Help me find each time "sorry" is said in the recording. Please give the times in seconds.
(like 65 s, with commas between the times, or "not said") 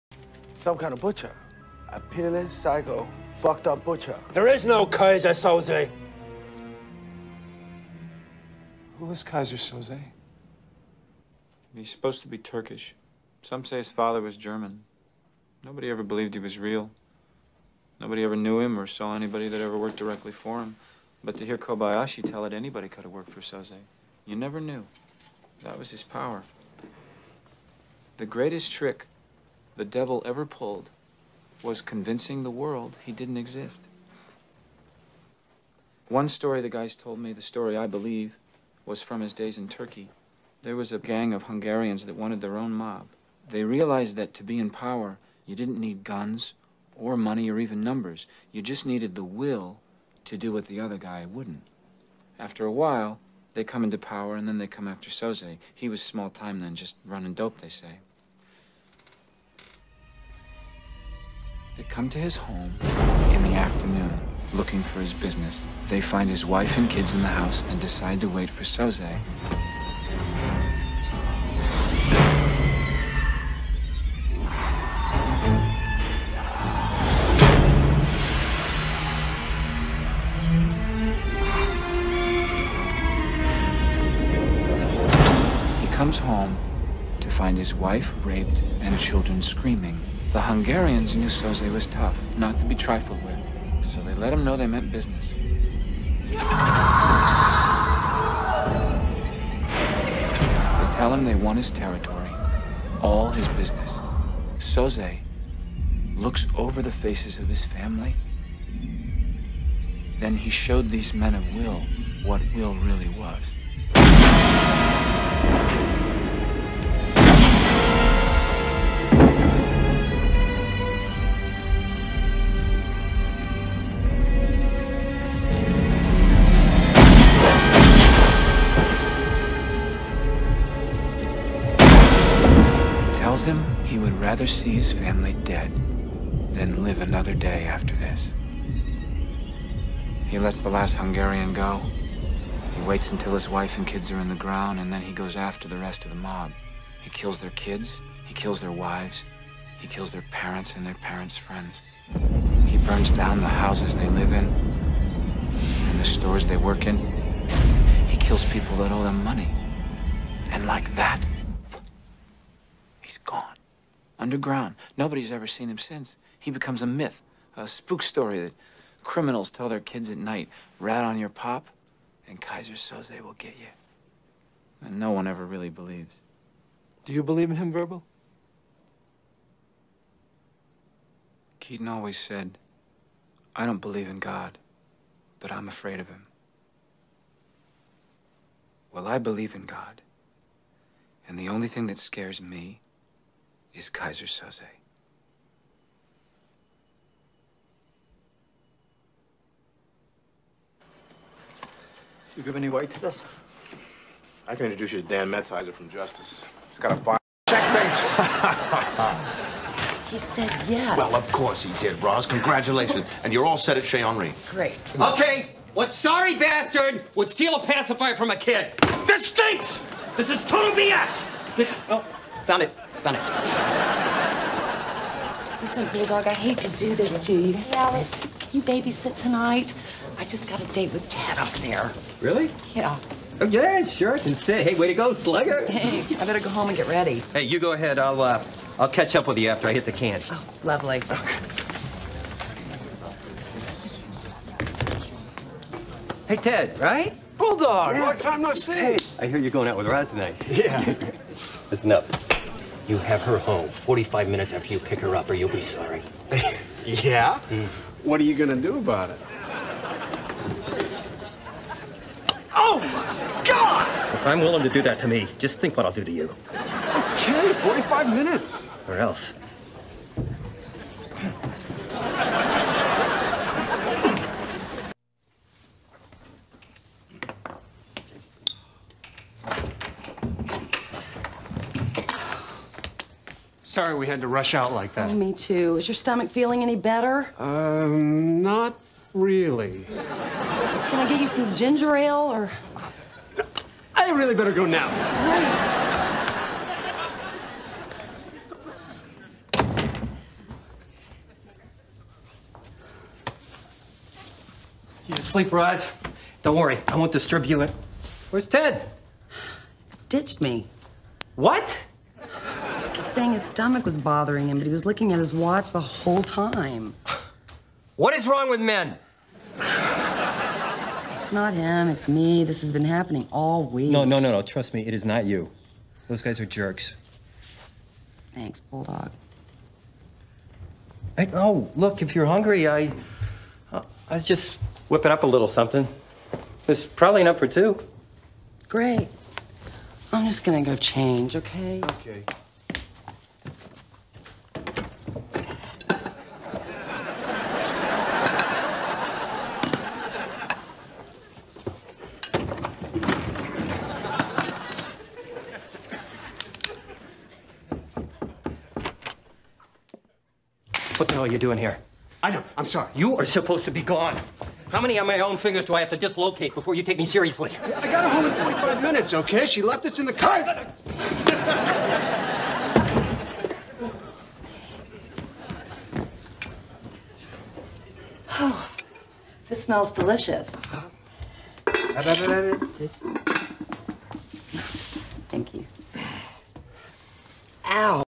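215 s, 255 s, 283 s, 362 s.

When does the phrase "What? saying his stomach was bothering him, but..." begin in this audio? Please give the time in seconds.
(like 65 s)
311 s.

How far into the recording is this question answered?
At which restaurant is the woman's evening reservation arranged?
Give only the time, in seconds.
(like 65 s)
213 s.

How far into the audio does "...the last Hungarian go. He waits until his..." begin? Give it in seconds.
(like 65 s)
140 s.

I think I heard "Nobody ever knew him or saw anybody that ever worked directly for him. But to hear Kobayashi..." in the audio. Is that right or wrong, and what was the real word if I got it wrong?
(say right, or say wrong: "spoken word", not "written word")
right.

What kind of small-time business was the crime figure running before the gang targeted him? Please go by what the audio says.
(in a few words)
Dope.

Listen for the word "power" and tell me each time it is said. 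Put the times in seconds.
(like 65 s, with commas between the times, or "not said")
26 s, 44 s, 53 s.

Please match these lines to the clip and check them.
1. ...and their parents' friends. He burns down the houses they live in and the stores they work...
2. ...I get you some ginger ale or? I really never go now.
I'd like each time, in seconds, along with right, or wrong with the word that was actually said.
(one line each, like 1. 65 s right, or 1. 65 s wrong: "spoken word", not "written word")
1. 150 s right
2. 290 s wrong: "better", not "never".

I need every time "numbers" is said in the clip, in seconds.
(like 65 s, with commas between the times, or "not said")
47 s.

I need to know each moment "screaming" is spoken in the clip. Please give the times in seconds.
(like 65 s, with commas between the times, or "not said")
89 s.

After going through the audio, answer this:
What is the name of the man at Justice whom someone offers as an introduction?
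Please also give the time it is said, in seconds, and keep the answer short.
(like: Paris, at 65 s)
Dan Metzheiser, at 205 s.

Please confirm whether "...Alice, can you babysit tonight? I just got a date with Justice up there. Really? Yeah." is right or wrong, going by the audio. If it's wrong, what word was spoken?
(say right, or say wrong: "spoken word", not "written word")
wrong: "Ted", not "Justice".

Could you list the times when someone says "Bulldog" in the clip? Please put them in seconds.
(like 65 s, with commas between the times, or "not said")
225 s, 247 s, 328 s.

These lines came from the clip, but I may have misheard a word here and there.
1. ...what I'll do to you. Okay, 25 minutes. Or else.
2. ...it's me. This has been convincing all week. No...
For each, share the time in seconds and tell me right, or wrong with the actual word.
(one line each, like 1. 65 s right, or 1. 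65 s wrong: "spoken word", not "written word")
1. 265 s wrong: "45", not "25"
2. 321 s wrong: "happening", not "convincing".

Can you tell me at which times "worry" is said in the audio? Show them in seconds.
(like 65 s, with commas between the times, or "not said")
306 s.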